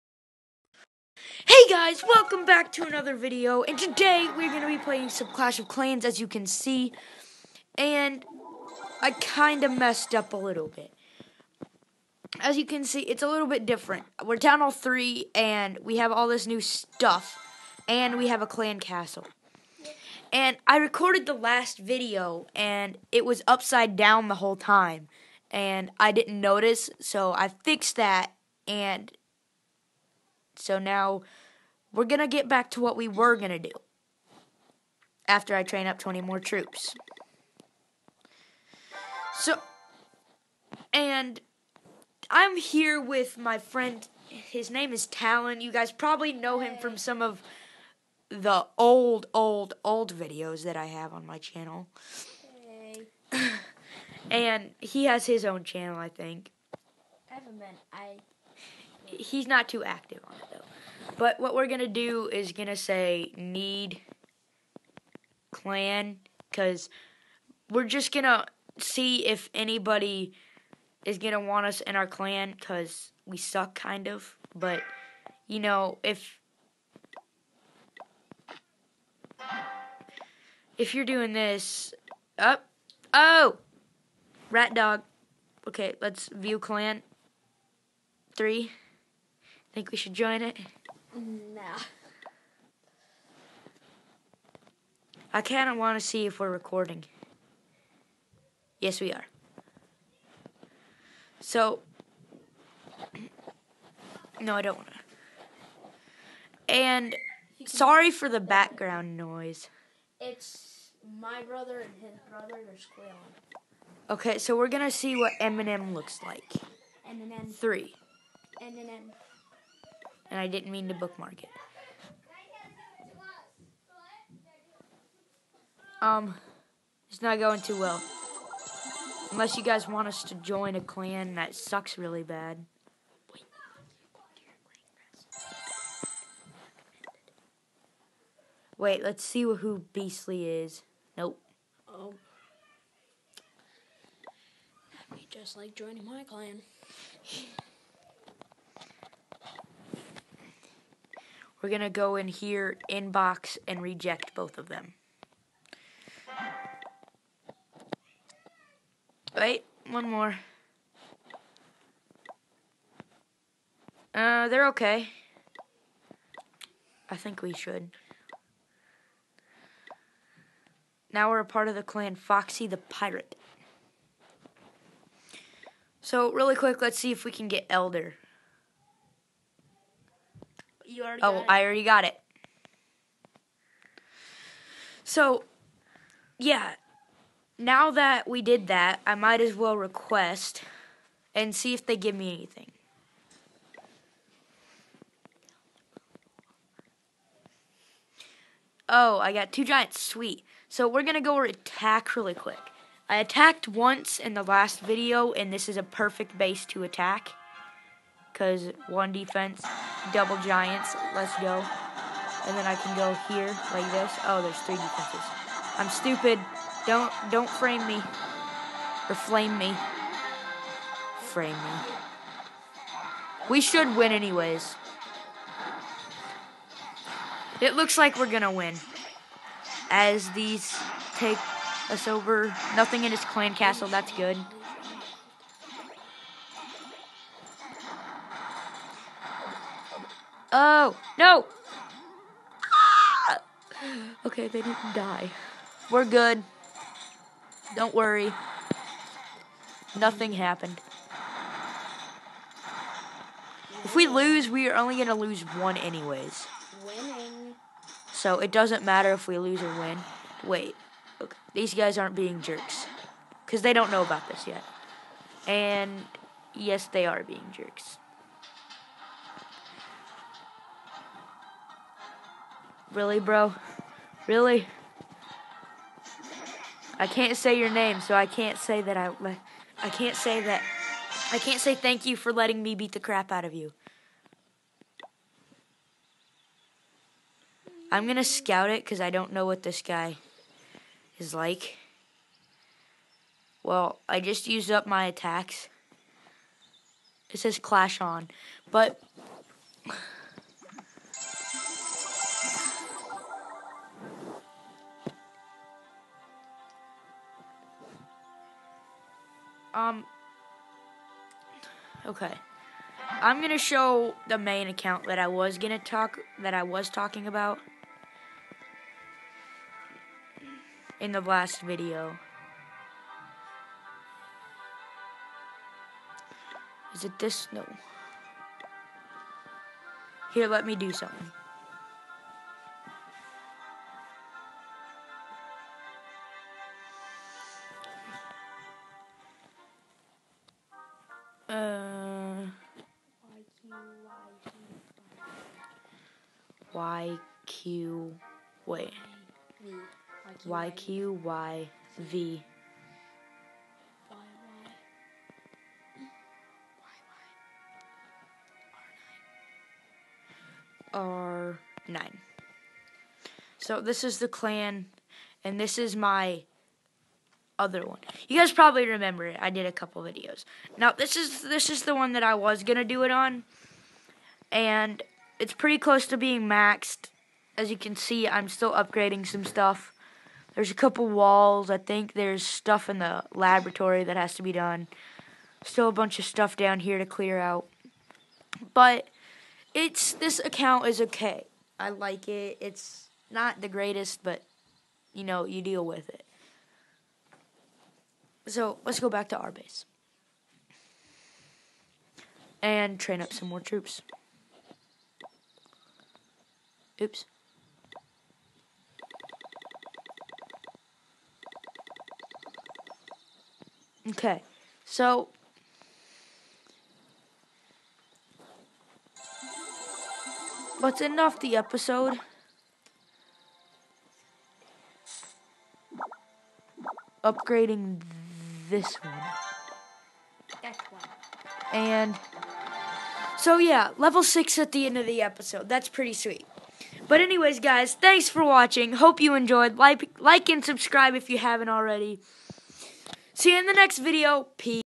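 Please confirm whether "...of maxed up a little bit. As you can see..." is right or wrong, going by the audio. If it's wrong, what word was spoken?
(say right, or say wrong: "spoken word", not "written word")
wrong: "messed", not "maxed".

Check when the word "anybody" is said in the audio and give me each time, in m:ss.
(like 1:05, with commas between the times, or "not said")
1:09.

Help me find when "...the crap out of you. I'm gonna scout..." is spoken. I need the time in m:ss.
4:42.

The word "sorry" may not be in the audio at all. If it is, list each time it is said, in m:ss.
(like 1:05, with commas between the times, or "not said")
1:47.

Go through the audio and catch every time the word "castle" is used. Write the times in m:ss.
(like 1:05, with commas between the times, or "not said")
0:18, 3:53.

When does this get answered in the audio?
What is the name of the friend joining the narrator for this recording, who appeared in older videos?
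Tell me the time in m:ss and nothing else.
0:45.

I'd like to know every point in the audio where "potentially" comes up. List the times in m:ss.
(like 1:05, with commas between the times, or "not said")
not said.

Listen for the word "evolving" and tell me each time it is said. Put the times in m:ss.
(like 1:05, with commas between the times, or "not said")
not said.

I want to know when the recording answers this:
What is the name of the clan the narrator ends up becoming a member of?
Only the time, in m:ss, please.
2:52.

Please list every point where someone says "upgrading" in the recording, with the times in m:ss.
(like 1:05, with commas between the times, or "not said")
6:18, 7:07.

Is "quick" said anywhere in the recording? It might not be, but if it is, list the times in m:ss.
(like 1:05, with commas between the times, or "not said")
2:56, 3:22.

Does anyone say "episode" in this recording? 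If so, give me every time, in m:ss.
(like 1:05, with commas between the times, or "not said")
7:01, 7:15.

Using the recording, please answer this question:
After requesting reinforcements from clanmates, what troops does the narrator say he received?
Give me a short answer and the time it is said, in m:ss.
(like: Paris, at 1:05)
two giants, at 3:19.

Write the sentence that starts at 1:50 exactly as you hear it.
It's my brother and his brother are squealing.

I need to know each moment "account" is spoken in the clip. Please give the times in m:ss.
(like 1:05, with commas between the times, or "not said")
5:14, 6:30.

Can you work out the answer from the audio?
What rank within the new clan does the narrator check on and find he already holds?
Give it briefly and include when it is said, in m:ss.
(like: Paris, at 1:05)
Elder, at 2:57.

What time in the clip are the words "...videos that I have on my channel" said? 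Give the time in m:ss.
0:50.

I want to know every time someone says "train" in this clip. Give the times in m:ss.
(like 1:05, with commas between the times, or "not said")
0:35, 6:42.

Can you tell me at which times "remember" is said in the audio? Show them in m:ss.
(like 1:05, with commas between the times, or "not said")
6:08.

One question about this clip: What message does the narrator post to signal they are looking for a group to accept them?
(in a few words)
need clan.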